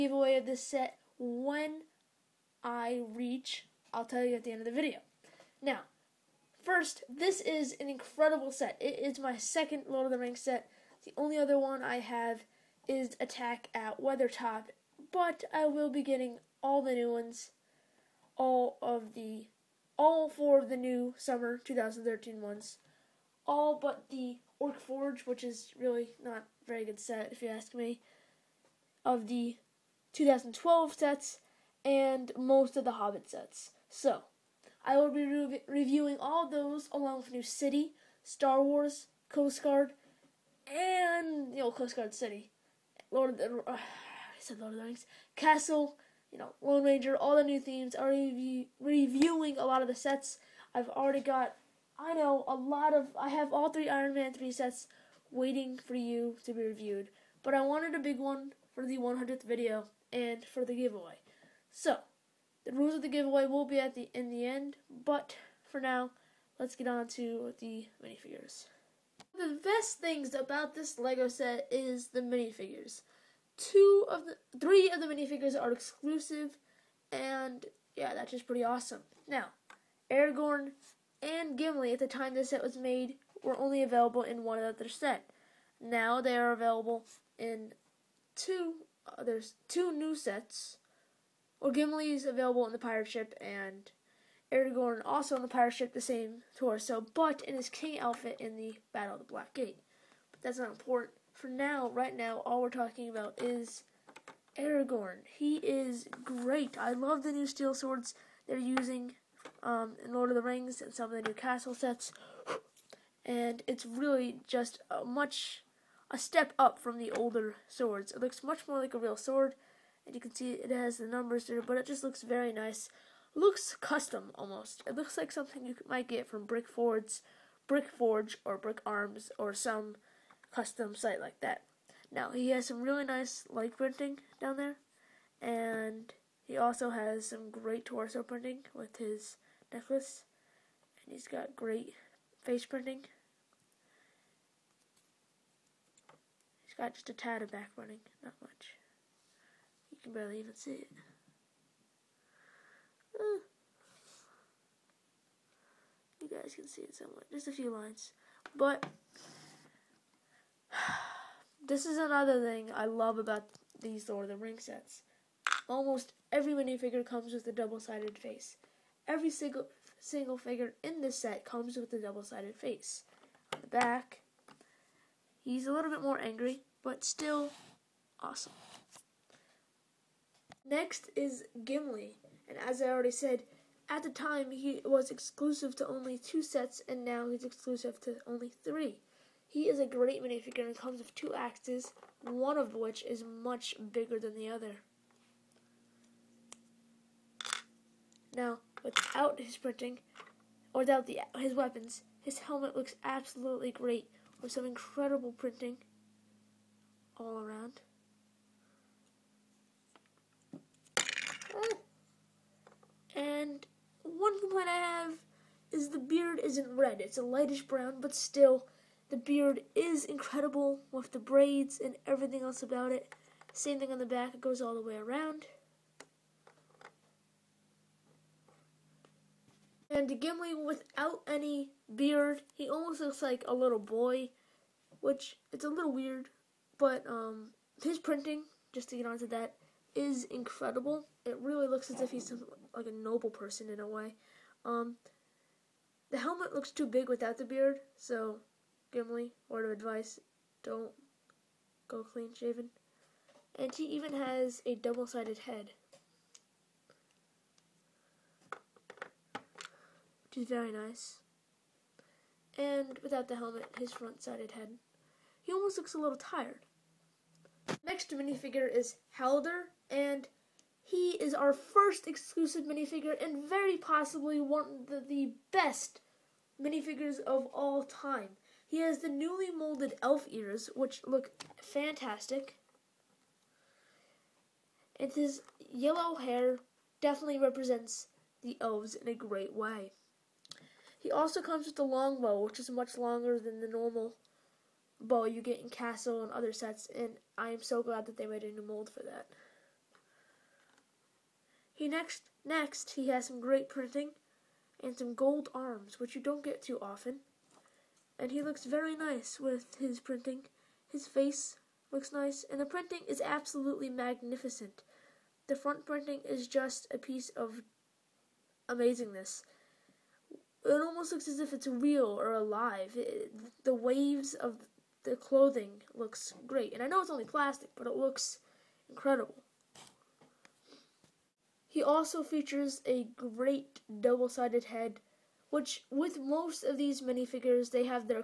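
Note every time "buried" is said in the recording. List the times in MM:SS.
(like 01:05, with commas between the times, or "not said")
not said.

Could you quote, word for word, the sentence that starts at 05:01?
He next next he has some great printing and some gold arms, which you don't get too often.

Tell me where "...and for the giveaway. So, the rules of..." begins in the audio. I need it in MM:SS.
01:00.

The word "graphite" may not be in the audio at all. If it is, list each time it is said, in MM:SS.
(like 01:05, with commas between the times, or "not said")
not said.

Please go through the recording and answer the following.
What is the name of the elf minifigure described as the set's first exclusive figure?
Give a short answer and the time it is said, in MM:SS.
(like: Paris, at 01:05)
Haldir, at 04:29.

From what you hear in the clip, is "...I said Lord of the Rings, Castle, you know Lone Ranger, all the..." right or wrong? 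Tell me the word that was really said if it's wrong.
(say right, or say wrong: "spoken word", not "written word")
right.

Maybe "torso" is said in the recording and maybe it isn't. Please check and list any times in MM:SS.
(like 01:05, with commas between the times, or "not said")
01:36, 02:17.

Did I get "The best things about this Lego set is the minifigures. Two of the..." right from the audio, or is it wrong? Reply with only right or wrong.
right.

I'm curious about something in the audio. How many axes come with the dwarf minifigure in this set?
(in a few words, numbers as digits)
2.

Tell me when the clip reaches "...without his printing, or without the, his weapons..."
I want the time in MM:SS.
03:18.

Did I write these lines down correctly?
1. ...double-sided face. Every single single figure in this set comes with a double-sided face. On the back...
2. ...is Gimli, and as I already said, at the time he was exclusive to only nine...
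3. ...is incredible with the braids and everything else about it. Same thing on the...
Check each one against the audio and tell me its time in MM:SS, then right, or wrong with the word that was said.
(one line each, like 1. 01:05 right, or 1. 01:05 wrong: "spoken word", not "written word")
1. 02:47 right
2. 03:01 wrong: "two", not "nine"
3. 03:39 right.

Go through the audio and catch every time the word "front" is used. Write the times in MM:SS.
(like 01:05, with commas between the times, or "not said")
04:23, 05:15.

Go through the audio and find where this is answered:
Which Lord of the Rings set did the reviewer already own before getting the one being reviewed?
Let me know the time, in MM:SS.
00:13.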